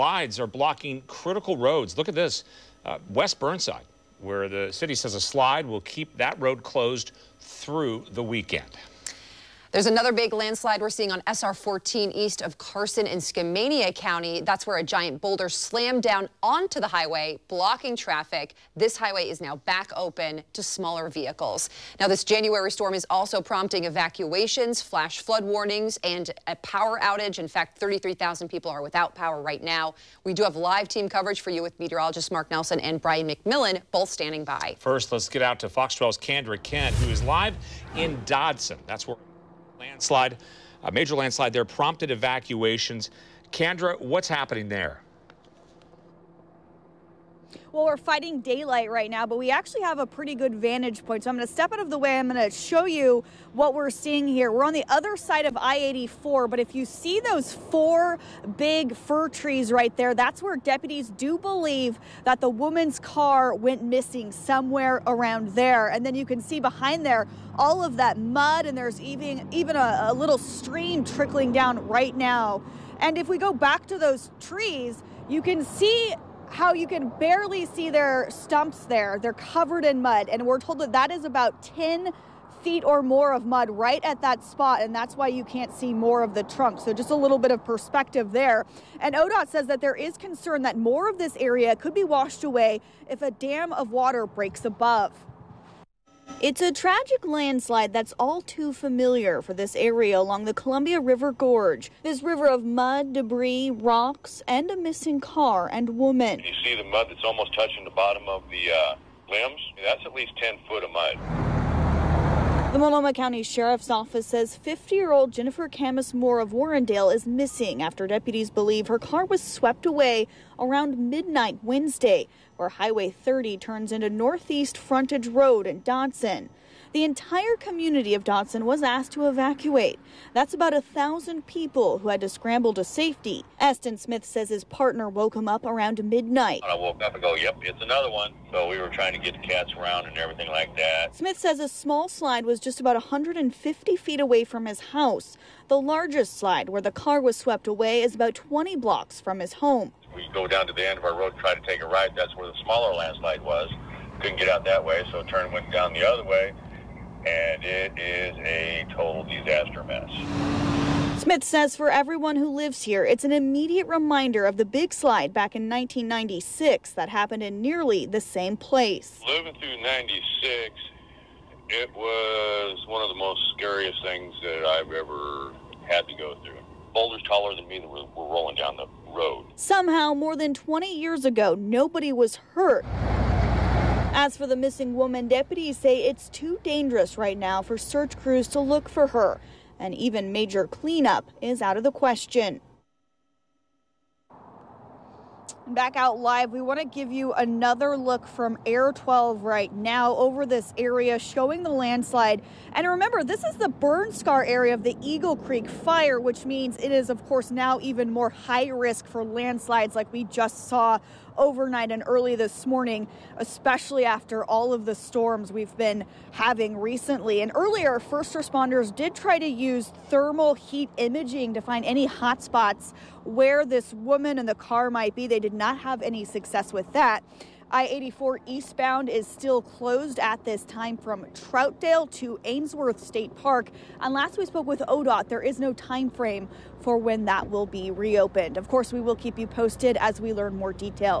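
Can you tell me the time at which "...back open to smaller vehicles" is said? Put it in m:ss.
0:19.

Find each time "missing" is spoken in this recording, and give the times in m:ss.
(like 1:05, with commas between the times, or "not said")
1:03, 1:44, 1:57, 3:04.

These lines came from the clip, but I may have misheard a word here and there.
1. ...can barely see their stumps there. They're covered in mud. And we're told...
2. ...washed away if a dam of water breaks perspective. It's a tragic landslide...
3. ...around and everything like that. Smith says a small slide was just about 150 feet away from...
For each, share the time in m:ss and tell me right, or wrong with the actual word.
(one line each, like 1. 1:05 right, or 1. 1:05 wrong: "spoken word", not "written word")
1. 1:16 right
2. 1:32 wrong: "above", not "perspective"
3. 2:19 right.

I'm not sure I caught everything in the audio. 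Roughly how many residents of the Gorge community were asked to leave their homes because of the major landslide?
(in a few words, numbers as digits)
1,000.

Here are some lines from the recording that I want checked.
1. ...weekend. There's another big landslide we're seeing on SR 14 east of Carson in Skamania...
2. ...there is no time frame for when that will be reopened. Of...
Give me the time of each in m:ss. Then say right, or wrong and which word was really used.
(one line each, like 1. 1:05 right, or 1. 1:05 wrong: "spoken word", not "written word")
1. 0:08 right
2. 3:55 right.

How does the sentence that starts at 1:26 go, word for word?
So just a little bit of perspective there.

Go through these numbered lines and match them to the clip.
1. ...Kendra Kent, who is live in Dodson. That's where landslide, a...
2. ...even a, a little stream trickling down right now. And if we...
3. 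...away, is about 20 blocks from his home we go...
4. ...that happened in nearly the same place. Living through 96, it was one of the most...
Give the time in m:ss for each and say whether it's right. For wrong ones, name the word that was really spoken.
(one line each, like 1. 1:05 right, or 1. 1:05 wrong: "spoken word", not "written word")
1. 0:36 right
2. 1:09 right
3. 2:27 right
4. 2:46 right.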